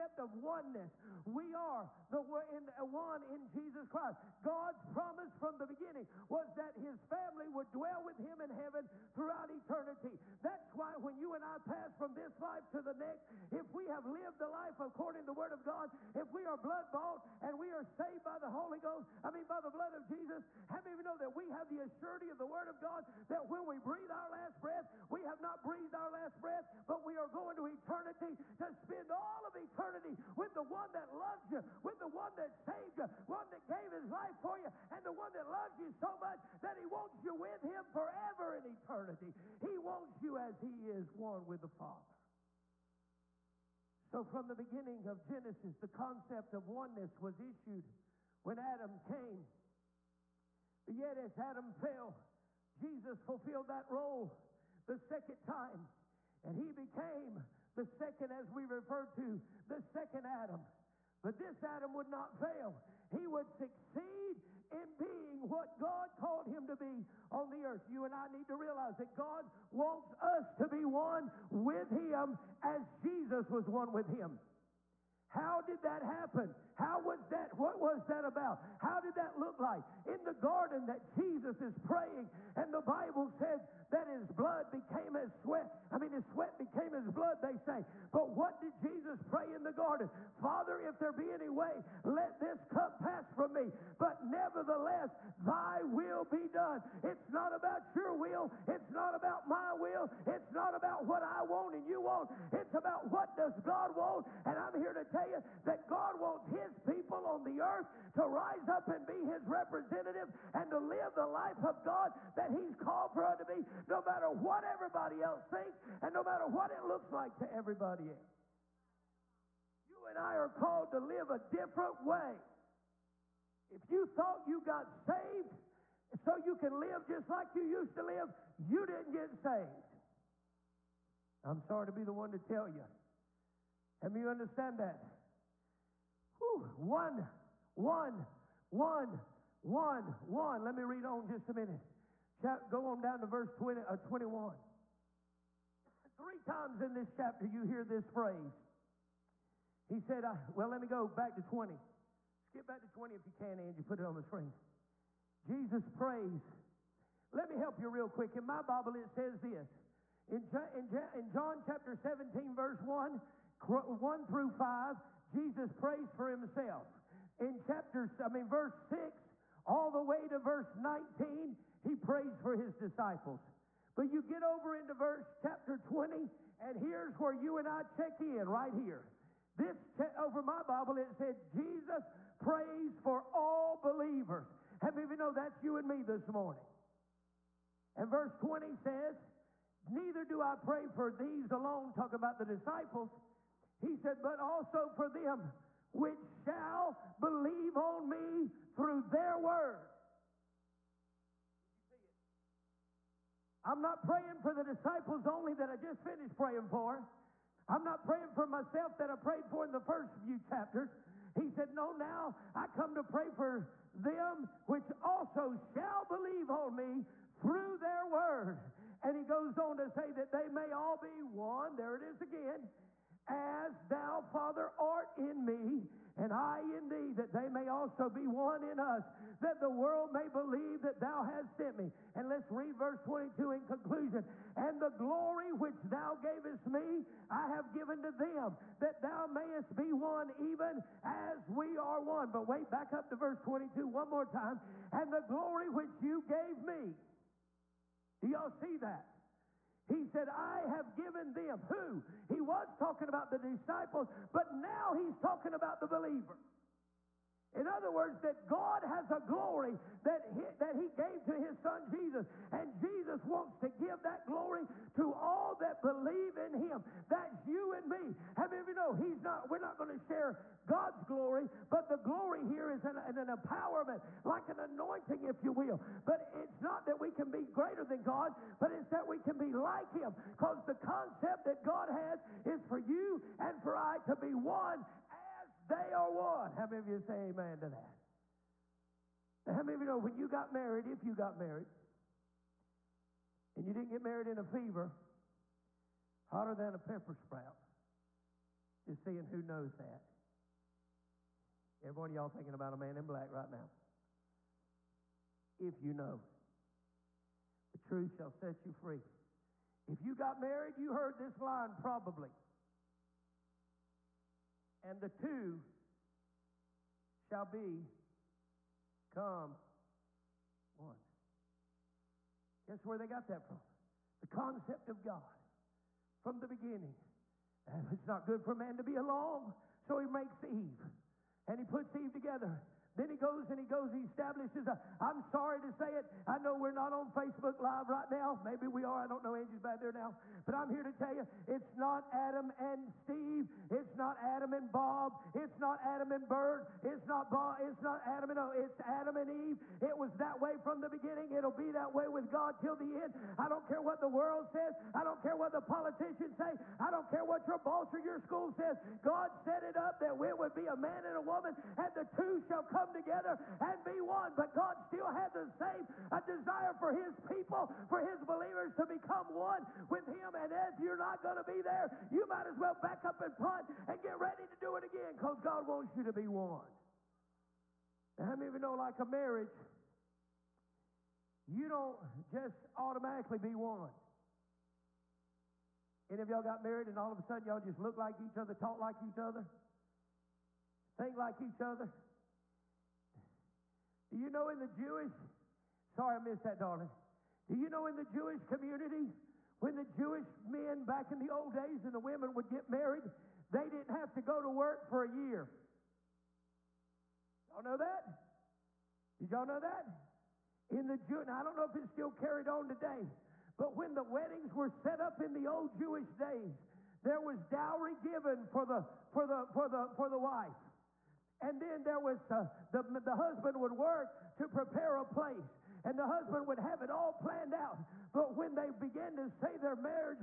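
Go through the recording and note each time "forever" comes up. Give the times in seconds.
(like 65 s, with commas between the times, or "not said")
38 s.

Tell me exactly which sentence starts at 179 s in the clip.
This che- over my Bible, it said, Jesus prays for all believers.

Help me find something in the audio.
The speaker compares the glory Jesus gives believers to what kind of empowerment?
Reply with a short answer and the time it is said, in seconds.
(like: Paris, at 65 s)
An anointing, at 274 s.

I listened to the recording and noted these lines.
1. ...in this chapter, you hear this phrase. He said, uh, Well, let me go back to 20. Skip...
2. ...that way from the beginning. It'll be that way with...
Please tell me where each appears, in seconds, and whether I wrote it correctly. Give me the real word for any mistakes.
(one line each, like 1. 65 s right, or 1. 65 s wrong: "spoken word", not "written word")
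1. 146 s right
2. 350 s right.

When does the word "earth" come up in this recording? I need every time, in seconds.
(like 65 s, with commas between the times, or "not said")
67 s, 107 s.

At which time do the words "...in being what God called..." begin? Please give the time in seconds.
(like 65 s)
64 s.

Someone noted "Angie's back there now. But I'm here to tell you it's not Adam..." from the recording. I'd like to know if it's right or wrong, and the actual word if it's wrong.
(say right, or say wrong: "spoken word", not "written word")
right.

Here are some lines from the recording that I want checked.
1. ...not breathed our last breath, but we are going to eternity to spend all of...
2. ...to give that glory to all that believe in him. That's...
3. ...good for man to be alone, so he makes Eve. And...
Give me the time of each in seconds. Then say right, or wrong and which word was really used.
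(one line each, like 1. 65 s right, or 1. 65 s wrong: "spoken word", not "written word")
1. 25 s right
2. 263 s right
3. 328 s right.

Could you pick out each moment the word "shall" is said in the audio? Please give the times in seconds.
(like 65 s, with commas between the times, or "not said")
196 s, 215 s, 308 s, 317 s, 362 s.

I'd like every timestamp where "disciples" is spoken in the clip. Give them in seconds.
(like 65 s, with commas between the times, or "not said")
172 s, 192 s, 204 s, 253 s.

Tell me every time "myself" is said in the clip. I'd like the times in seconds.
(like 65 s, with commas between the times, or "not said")
208 s.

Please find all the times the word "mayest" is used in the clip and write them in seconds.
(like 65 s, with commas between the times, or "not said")
239 s.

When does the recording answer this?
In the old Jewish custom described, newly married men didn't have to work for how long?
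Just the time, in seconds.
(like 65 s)
405 s.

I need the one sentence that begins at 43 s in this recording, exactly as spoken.
So, from the beginning of Genesis, the concept of oneness was issued when Adam came.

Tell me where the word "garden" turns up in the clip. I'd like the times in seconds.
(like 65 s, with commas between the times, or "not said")
80 s, 89 s.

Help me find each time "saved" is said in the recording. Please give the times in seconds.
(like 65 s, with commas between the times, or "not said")
17 s, 32 s, 124 s, 129 s.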